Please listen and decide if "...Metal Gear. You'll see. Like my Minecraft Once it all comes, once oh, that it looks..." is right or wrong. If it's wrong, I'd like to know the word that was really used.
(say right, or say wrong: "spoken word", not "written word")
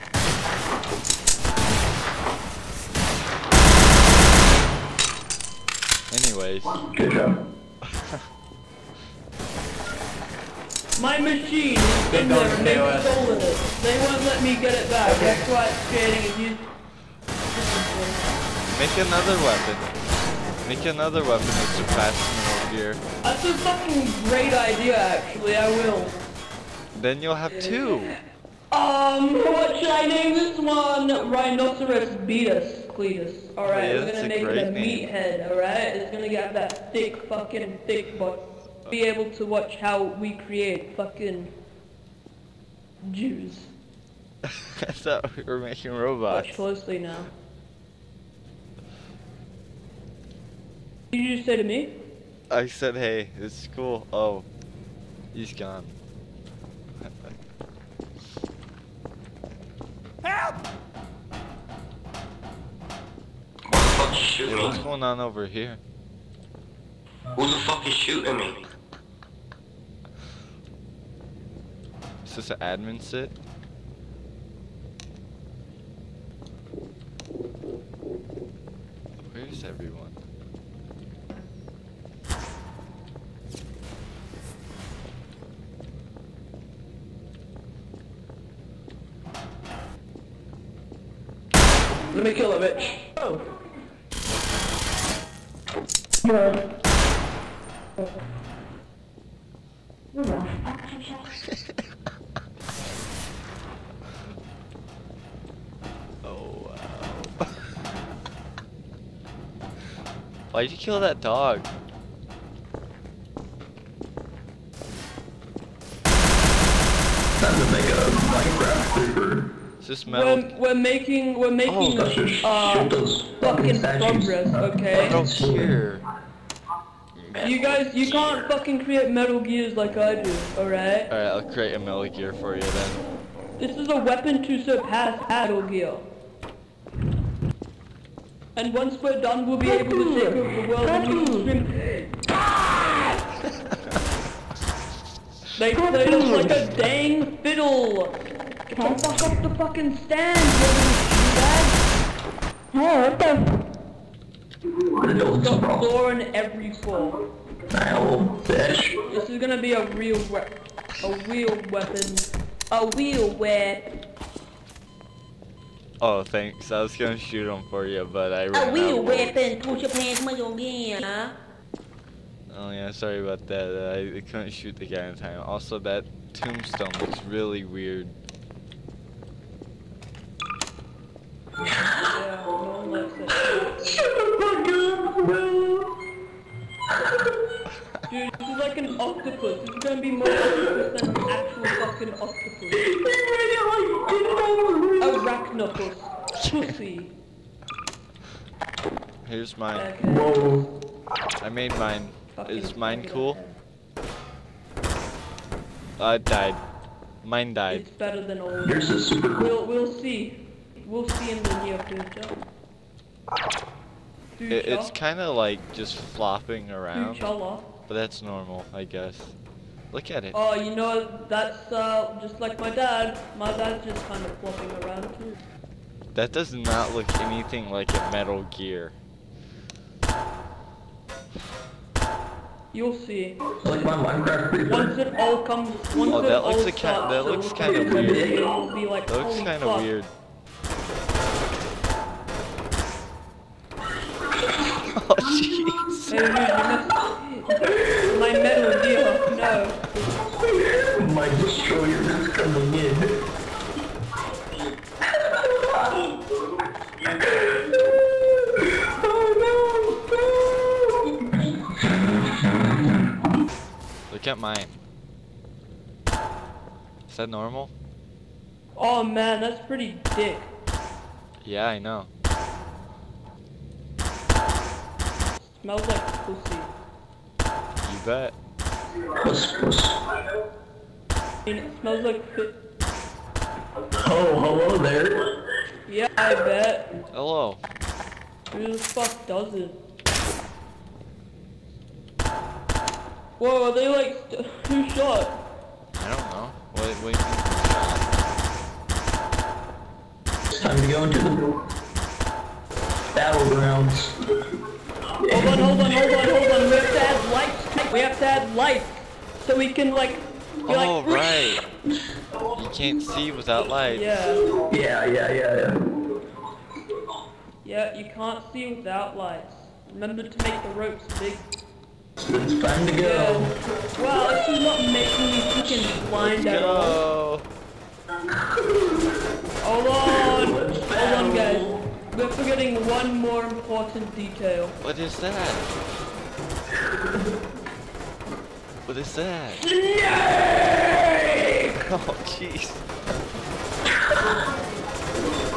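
right.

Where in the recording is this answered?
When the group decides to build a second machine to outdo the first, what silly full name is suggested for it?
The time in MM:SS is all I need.
00:31.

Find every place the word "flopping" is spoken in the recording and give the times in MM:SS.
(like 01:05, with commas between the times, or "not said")
03:35, 03:44.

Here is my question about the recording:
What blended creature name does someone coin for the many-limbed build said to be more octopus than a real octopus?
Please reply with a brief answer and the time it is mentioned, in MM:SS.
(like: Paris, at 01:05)
Arachnopus, at 03:15.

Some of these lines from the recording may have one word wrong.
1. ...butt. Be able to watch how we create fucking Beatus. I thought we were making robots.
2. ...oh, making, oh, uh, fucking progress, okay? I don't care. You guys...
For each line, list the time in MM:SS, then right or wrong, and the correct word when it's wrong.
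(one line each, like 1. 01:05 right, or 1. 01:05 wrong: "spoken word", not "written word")
1. 00:38 wrong: "Jews", not "Beatus"
2. 02:01 right.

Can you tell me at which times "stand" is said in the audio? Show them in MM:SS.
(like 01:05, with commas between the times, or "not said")
02:29.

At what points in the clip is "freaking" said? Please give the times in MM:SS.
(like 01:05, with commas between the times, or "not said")
05:25.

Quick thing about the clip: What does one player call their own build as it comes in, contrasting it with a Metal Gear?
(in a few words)
destroyer.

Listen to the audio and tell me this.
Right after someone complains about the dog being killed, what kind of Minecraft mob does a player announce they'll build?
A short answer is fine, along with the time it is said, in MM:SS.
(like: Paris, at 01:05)
creeper, at 01:58.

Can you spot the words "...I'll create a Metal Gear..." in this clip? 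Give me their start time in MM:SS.
02:11.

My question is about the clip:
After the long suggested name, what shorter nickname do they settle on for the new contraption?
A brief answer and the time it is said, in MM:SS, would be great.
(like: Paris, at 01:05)
meathead, at 00:35.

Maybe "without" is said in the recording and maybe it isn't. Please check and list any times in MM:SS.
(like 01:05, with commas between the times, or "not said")
05:13, 05:18.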